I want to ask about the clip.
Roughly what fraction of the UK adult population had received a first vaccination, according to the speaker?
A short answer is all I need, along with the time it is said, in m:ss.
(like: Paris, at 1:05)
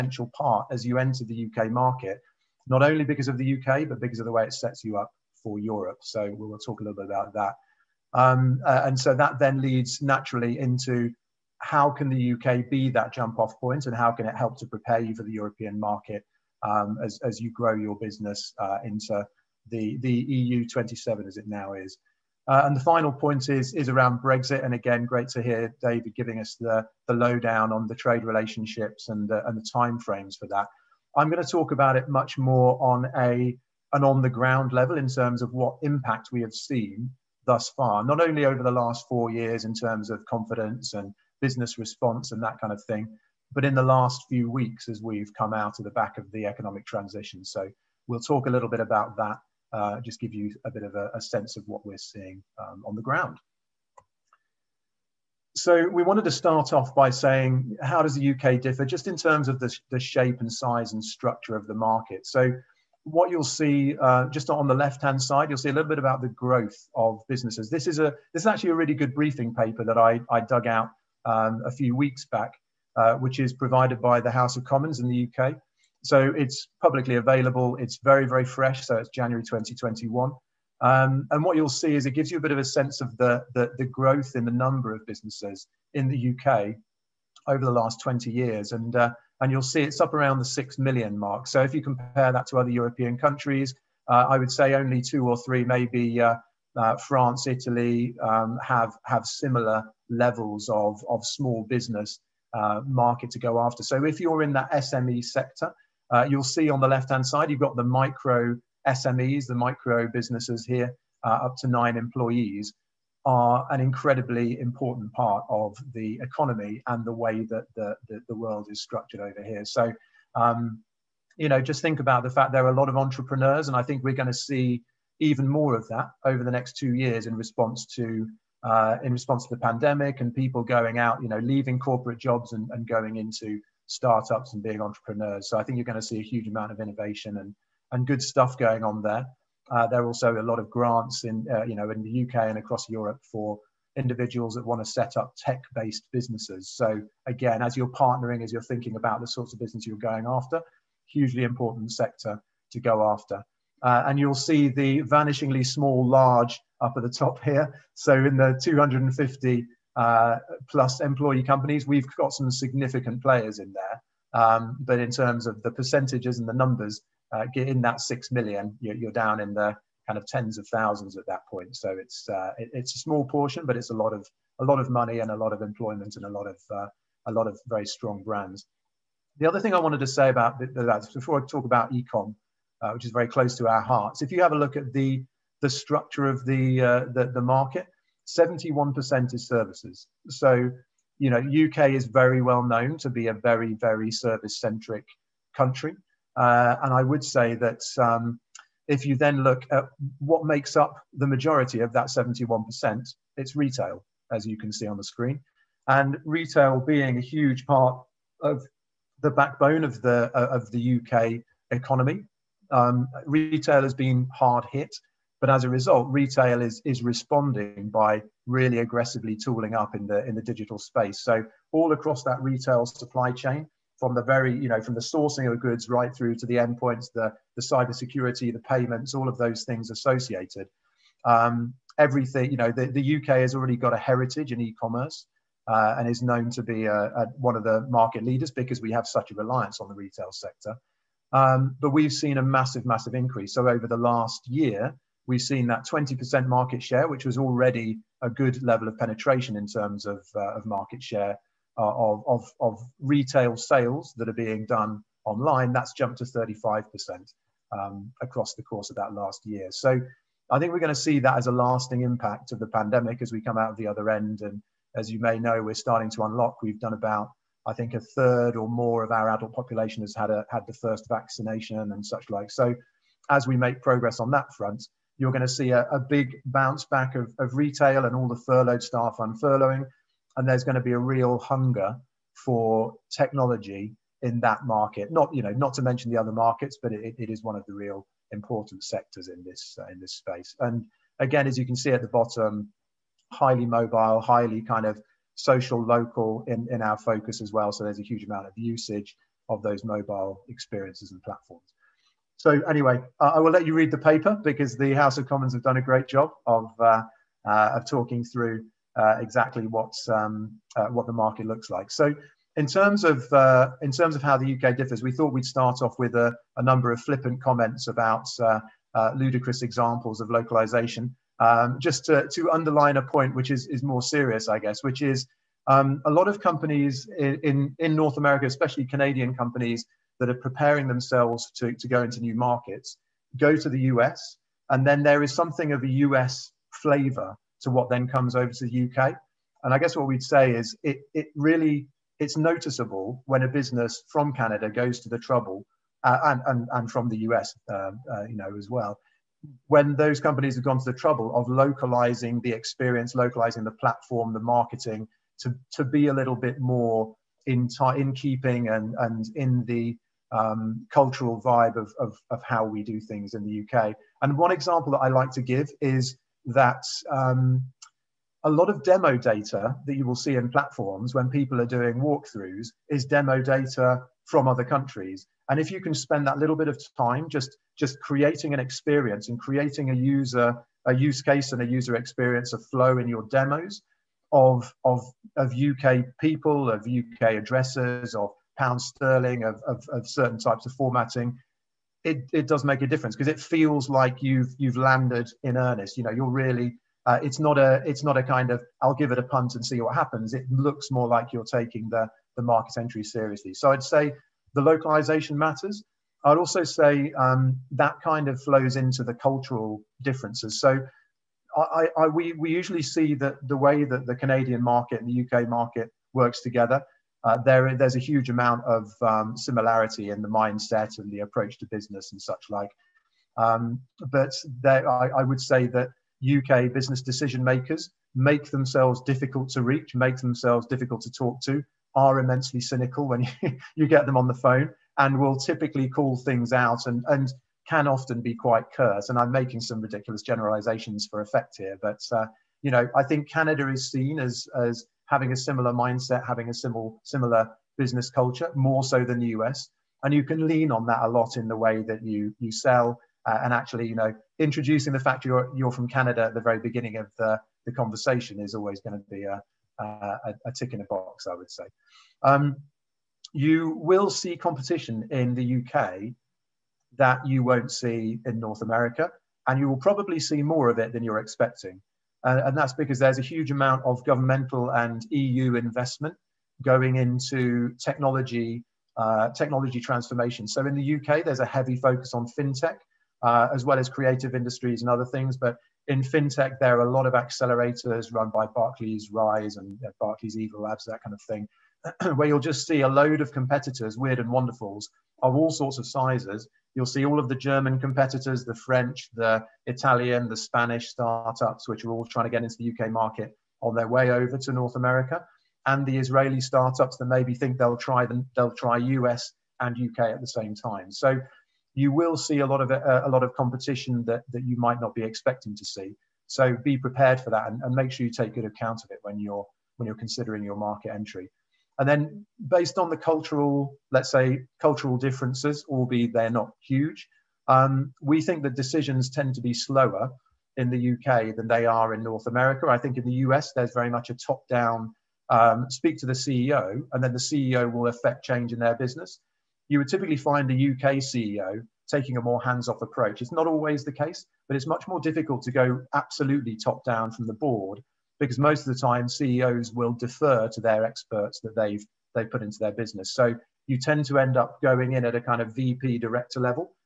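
a third, at 4:27.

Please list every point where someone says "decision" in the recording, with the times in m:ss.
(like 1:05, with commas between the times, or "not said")
7:07, 8:48.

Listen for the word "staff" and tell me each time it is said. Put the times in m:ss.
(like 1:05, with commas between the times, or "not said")
4:38.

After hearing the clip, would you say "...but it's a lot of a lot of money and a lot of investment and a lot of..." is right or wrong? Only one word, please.
wrong.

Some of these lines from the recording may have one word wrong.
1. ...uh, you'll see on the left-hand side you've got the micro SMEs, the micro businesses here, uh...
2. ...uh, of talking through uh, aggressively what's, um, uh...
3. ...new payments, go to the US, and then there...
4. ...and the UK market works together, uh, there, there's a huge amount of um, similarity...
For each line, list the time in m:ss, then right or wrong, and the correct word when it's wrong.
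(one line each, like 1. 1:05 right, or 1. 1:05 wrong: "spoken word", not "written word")
1. 1:46 right
2. 5:07 wrong: "exactly", not "aggressively"
3. 5:32 wrong: "markets", not "payments"
4. 6:55 right.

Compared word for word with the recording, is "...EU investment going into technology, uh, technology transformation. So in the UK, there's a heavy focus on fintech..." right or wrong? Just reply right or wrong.
right.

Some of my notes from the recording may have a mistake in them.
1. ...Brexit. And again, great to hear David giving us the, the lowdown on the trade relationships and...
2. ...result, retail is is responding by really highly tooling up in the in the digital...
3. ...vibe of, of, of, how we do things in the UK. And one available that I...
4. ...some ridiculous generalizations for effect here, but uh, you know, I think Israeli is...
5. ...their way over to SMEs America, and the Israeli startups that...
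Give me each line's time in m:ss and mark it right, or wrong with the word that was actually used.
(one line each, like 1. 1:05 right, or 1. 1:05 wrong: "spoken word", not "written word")
1. 0:24 right
2. 3:35 wrong: "aggressively", not "highly"
3. 6:01 wrong: "example", not "available"
4. 7:19 wrong: "Canada", not "Israeli"
5. 8:23 wrong: "North", not "SMEs".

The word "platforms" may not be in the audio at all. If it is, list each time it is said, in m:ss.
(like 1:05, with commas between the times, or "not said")
5:01, 5:53, 6:10.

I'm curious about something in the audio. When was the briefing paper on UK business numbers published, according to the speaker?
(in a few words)
January 2021.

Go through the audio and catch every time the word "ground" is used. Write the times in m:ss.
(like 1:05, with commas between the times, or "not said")
0:34, 0:53.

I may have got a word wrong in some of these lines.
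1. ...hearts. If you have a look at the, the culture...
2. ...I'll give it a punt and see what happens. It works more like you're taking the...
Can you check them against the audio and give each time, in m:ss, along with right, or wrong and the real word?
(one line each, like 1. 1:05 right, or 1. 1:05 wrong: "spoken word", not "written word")
1. 3:03 wrong: "structure", not "culture"
2. 6:38 wrong: "looks", not "works".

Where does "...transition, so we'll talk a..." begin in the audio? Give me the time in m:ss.
0:46.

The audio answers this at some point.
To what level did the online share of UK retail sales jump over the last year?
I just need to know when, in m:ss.
4:16.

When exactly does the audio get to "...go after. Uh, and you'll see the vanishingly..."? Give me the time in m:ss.
2:32.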